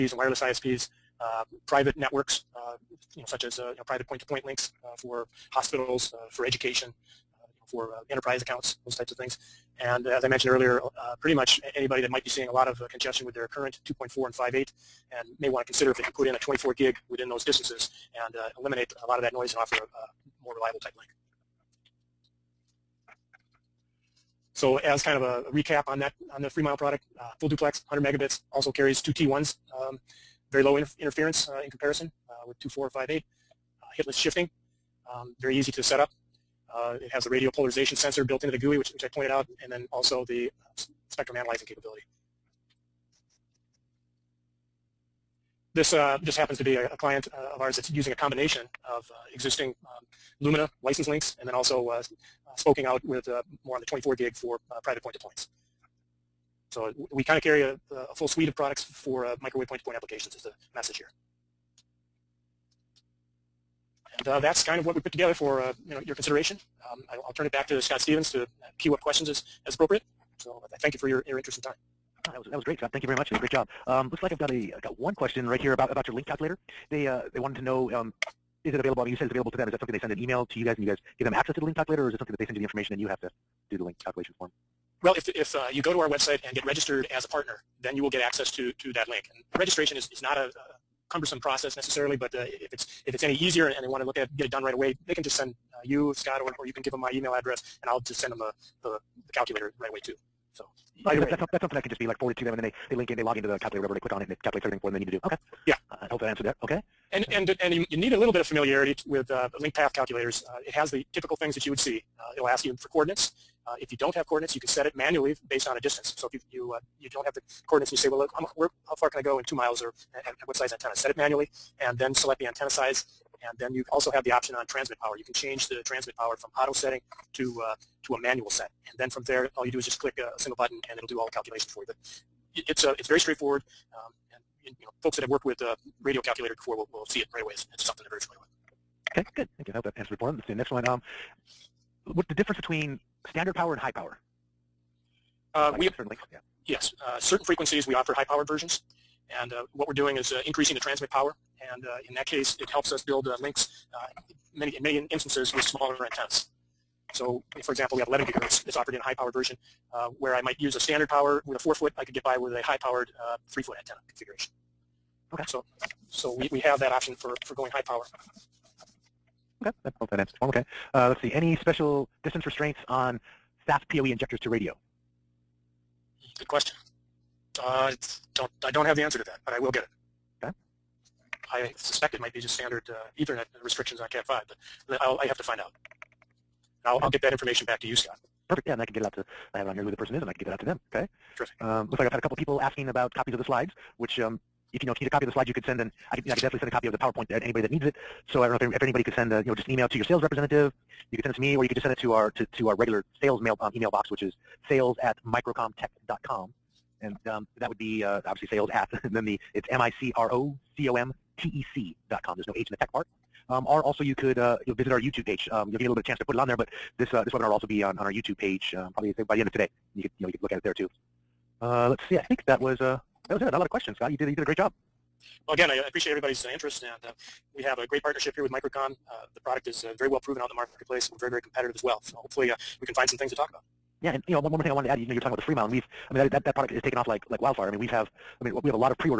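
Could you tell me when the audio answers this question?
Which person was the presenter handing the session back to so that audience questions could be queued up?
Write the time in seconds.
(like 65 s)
67 s.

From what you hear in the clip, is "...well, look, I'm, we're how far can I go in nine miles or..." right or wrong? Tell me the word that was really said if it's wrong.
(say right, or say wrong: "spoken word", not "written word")
wrong: "two", not "nine".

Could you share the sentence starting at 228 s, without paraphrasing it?
Uh, the product is uh, very well proven out in the marketplace.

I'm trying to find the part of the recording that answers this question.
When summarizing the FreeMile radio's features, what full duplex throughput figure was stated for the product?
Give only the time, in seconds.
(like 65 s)
27 s.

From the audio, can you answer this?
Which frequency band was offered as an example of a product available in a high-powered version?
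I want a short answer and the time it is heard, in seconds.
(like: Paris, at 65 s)
11 gigahertz, at 158 s.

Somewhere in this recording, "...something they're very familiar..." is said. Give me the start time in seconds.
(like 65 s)
137 s.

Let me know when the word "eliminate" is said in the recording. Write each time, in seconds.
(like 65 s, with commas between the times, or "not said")
18 s.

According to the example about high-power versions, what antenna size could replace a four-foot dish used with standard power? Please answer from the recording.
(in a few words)
3 foot.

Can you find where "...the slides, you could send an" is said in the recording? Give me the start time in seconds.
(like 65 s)
195 s.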